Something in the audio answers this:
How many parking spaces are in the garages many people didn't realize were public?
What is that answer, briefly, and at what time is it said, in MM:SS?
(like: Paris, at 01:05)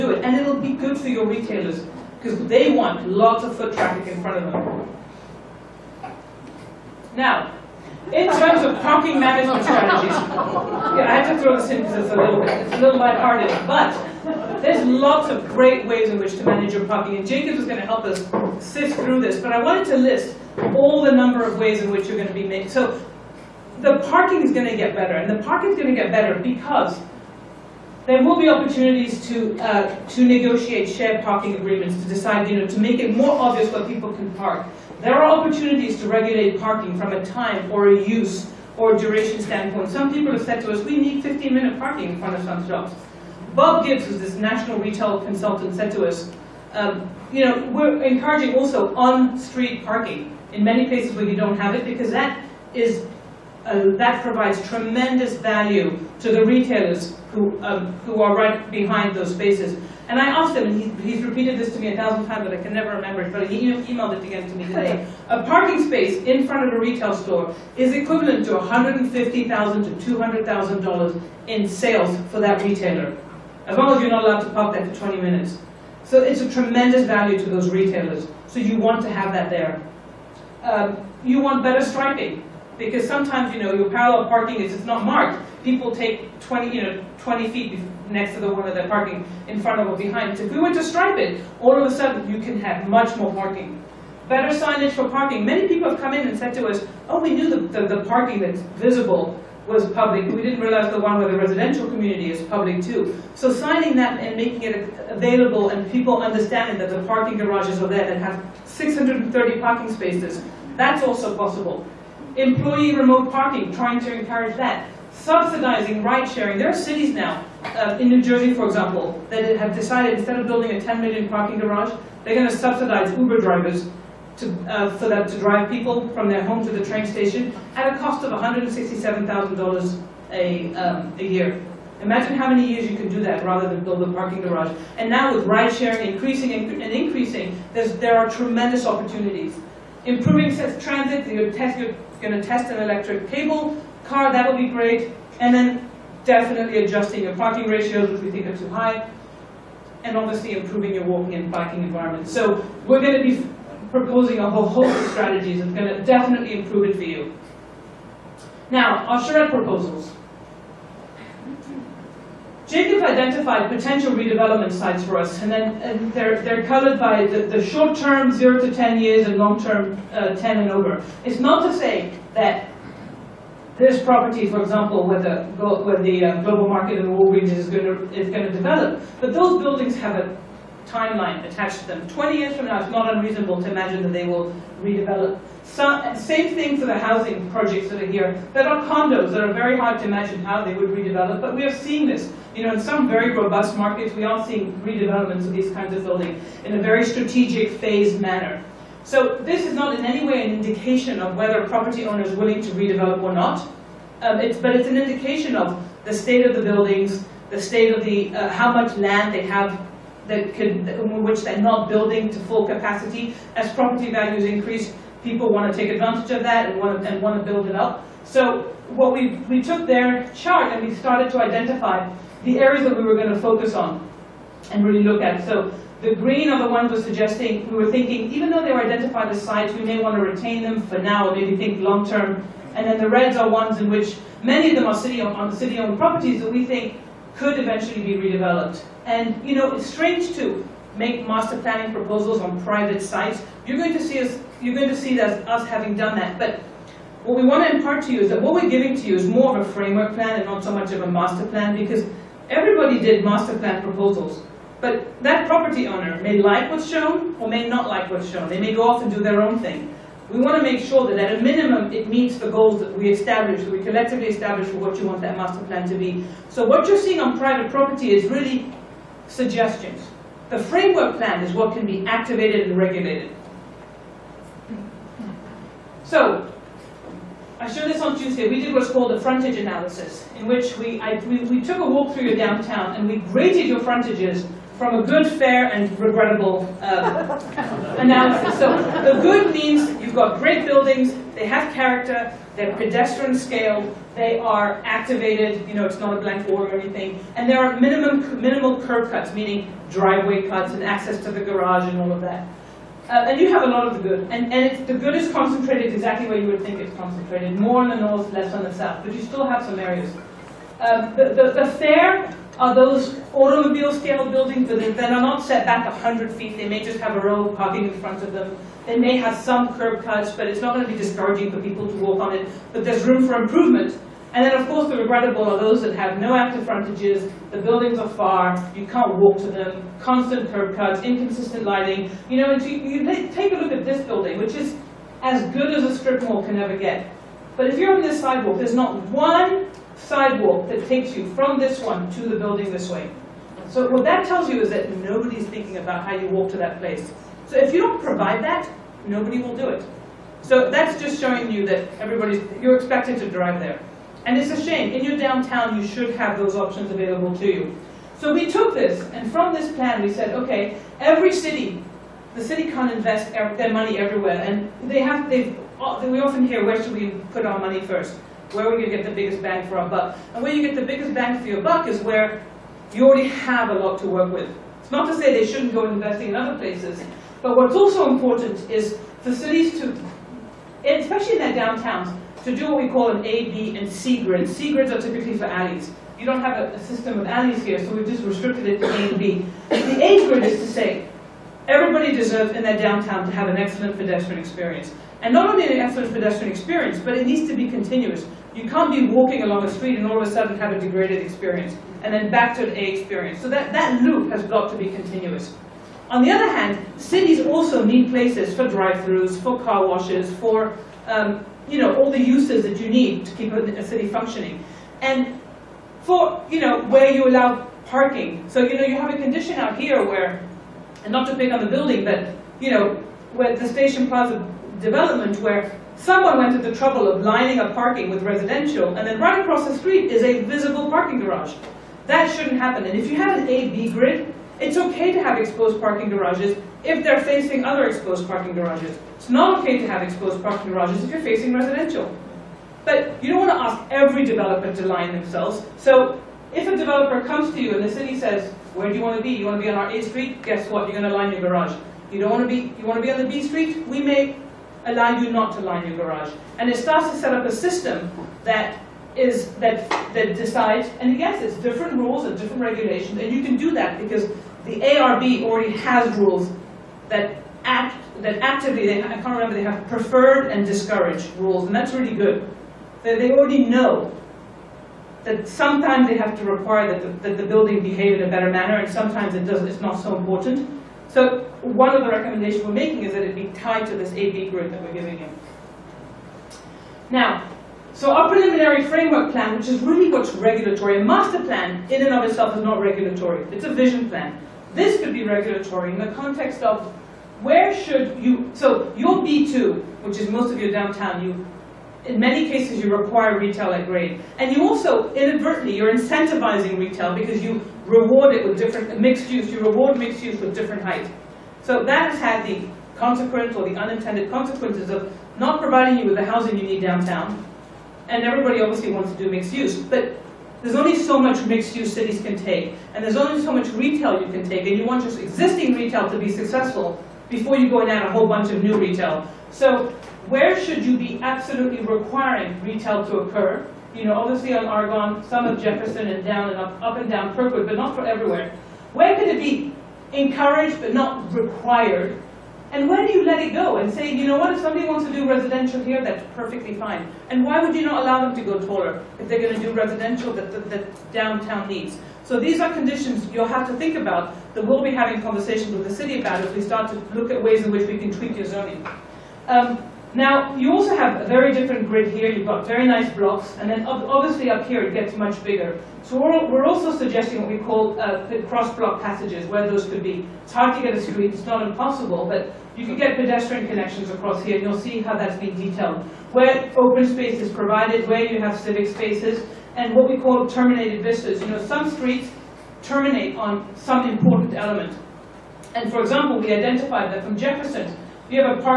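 630, at 01:48.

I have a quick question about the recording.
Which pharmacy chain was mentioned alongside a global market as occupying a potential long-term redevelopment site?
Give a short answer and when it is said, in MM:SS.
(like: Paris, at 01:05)
Walgreens, at 02:57.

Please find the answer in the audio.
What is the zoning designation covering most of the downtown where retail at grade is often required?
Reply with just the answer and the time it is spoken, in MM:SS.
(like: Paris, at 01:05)
B2, at 08:19.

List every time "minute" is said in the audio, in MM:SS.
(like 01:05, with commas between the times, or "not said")
00:41, 01:15.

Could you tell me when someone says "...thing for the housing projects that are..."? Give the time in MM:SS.
03:06.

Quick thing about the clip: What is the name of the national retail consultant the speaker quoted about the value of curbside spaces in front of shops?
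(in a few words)
Bob Gibbs.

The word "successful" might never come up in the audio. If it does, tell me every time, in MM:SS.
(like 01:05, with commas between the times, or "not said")
08:46.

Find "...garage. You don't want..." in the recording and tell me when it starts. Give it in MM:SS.
07:31.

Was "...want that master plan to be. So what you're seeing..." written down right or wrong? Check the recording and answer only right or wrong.
right.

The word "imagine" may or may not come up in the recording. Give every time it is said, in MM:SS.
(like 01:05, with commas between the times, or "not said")
02:12, 03:03, 03:10.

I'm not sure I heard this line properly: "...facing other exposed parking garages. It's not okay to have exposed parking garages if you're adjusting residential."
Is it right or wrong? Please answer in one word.
wrong.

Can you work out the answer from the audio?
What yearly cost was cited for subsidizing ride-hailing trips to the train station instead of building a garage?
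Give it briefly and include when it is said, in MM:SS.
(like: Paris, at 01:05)
$167,000, at 02:08.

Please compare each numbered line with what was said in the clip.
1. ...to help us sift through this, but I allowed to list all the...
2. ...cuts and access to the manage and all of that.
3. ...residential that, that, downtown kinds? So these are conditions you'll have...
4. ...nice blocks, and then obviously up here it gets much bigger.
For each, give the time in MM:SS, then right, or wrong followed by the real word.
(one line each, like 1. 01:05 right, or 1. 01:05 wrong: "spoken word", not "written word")
1. 00:17 wrong: "wanted", not "allowed"
2. 05:00 wrong: "garage", not "manage"
3. 09:09 wrong: "needs", not "kinds"
4. 09:22 right.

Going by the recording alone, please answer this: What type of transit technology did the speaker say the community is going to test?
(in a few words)
electric cable car.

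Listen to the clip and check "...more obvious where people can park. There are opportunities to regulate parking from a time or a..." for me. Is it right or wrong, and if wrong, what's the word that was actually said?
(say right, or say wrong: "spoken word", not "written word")
right.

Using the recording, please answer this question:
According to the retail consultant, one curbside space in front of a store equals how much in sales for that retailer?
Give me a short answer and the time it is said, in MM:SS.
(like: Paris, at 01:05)
$150,000 to $200,000, at 01:08.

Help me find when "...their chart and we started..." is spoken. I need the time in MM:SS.
03:39.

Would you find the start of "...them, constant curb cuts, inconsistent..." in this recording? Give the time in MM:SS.
05:29.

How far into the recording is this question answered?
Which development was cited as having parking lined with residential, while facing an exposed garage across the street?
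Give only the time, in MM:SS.
07:03.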